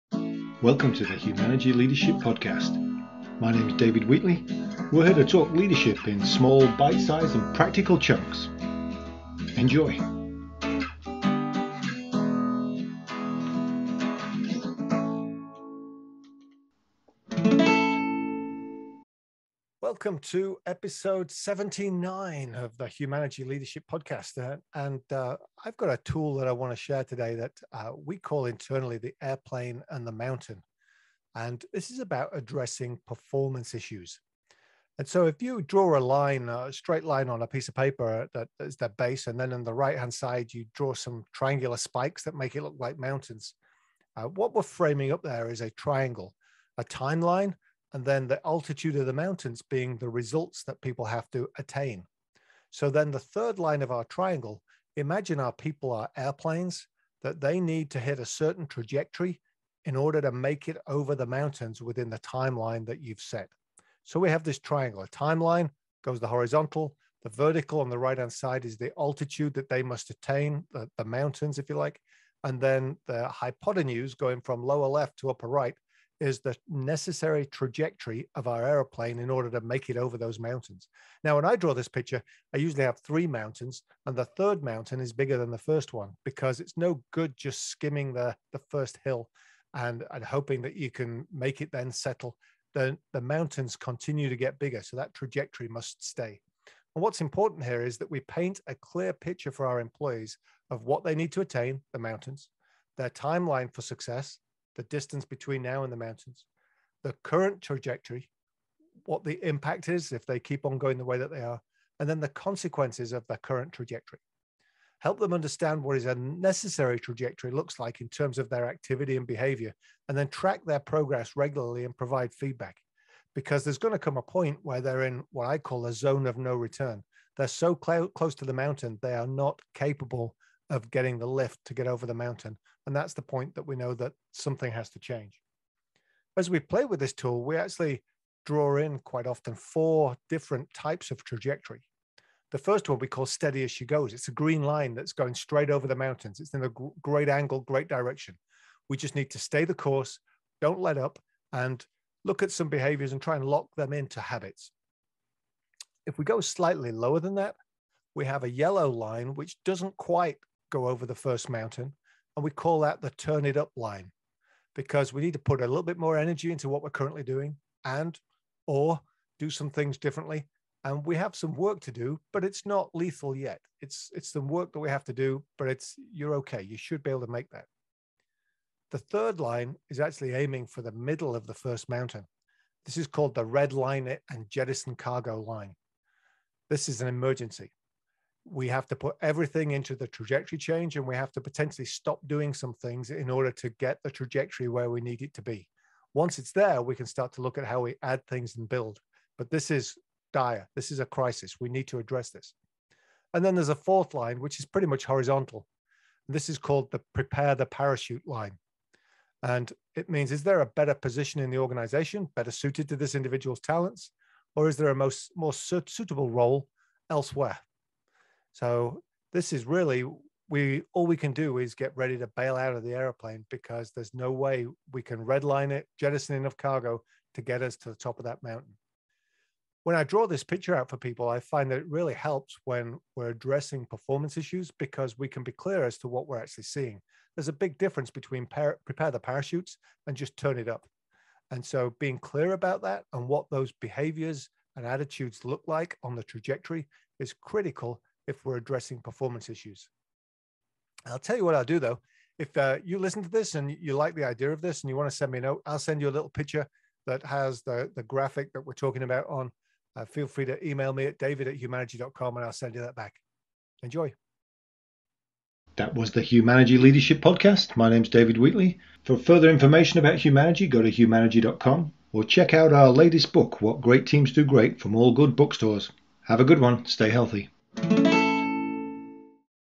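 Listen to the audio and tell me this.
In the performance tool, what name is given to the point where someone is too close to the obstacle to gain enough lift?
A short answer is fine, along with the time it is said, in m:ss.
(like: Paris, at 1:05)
Zone of no return, at 2:05.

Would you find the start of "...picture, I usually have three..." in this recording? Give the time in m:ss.
1:21.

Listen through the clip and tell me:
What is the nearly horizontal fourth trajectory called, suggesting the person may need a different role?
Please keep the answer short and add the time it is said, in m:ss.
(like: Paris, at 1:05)
Prepare the parachute line, at 3:27.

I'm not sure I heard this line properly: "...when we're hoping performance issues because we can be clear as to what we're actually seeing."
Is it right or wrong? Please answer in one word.
wrong.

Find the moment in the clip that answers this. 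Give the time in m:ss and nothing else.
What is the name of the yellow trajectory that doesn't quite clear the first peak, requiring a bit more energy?
2:43.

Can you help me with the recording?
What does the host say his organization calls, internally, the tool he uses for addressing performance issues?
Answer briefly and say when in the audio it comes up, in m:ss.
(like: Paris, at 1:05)
The airplane and the mountain, at 0:28.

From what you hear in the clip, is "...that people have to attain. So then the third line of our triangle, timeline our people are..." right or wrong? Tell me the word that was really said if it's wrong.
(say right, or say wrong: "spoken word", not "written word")
wrong: "imagine", not "timeline".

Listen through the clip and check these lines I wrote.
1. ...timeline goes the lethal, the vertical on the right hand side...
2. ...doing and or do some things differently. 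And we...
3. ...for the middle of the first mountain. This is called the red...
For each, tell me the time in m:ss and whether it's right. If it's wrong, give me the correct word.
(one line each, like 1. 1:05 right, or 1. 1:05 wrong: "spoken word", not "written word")
1. 1:05 wrong: "horizontal", not "lethal"
2. 2:47 right
3. 3:00 right.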